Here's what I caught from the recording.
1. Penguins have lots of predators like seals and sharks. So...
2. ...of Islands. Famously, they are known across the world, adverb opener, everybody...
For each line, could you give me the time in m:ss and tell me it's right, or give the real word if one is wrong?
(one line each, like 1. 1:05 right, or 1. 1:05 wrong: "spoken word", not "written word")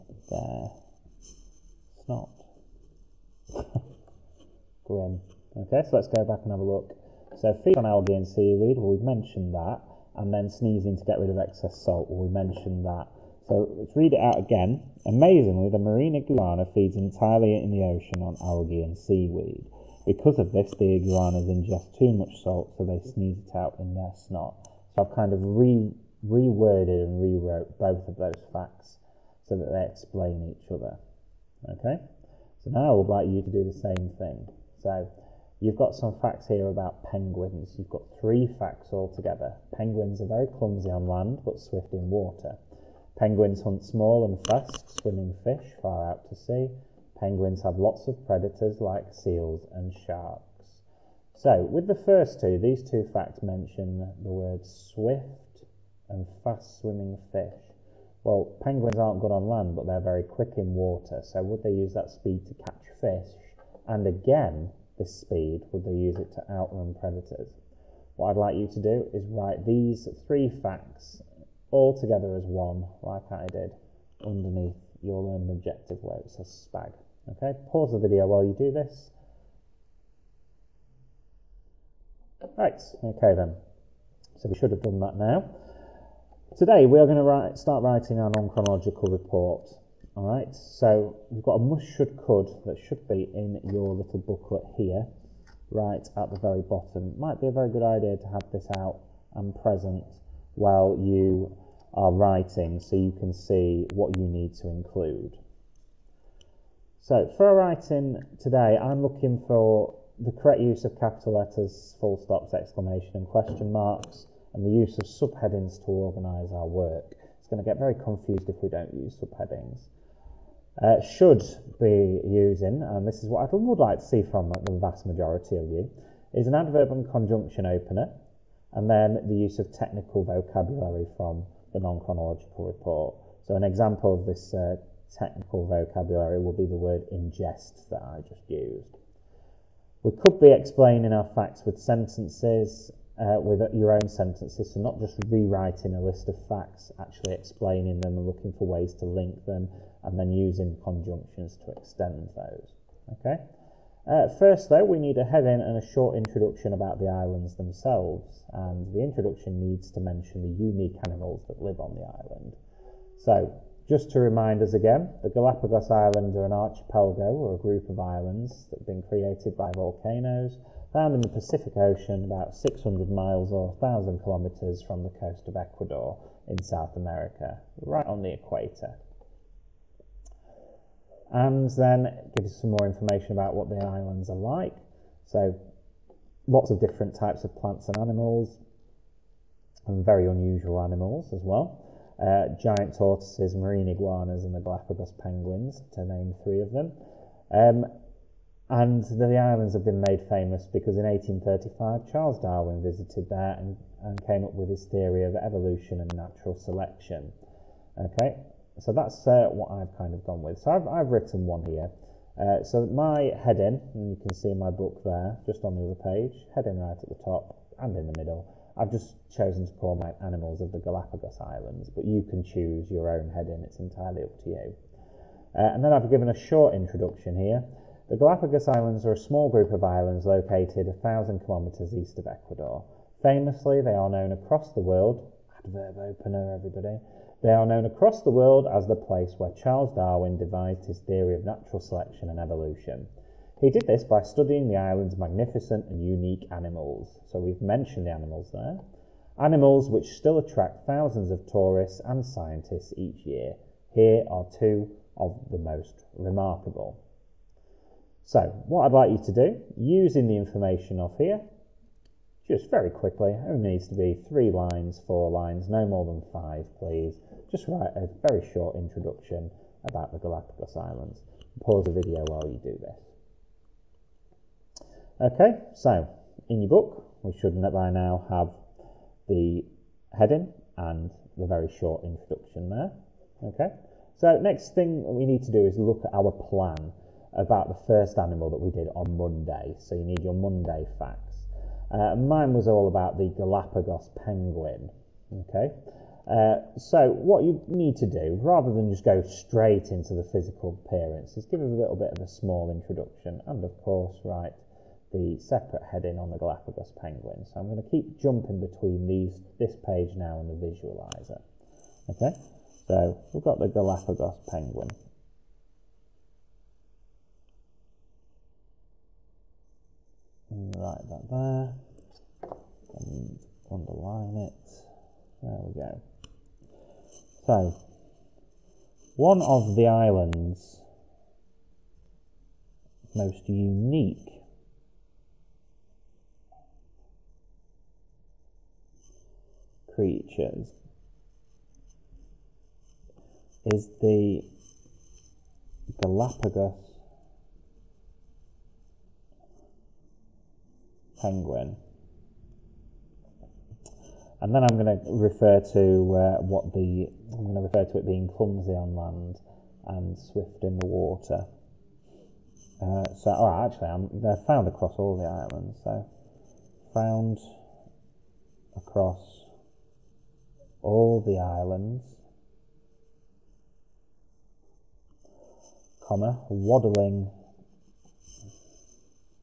1. 0:47 right
2. 3:52 wrong: "Ecuador", not "Islands".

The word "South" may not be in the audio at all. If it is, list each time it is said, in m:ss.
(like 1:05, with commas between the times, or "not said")
2:56.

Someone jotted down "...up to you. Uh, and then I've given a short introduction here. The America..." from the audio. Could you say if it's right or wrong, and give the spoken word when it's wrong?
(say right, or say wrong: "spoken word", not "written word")
wrong: "Galapagos", not "America".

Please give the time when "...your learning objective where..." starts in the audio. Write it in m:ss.
1:15.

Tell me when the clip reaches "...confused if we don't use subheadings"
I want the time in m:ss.
1:57.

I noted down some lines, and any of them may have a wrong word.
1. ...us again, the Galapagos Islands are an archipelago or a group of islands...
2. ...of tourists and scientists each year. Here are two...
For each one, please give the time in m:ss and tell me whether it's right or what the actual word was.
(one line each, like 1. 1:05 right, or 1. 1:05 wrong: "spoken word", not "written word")
1. 2:44 right
2. 4:11 right.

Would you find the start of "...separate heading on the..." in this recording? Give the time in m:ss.
5:05.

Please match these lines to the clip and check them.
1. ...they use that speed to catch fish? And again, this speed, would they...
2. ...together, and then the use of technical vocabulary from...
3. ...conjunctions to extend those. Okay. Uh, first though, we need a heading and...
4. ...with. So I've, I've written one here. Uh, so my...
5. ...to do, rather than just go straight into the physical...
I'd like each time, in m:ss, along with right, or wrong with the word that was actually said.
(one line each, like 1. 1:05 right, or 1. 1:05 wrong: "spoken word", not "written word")
1. 1:01 right
2. 2:07 wrong: "opener", not "together"
3. 2:30 right
4. 3:30 right
5. 4:57 right.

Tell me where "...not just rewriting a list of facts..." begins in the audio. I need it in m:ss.
2:24.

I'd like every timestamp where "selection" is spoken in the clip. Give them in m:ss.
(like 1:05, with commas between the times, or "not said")
3:26, 4:01.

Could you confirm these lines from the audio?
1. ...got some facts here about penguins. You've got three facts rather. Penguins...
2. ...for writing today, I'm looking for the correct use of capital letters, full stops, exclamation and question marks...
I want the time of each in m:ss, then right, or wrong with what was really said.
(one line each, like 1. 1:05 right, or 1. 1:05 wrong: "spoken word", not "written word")
1. 0:35 wrong: "altogether", not "rather"
2. 1:47 right.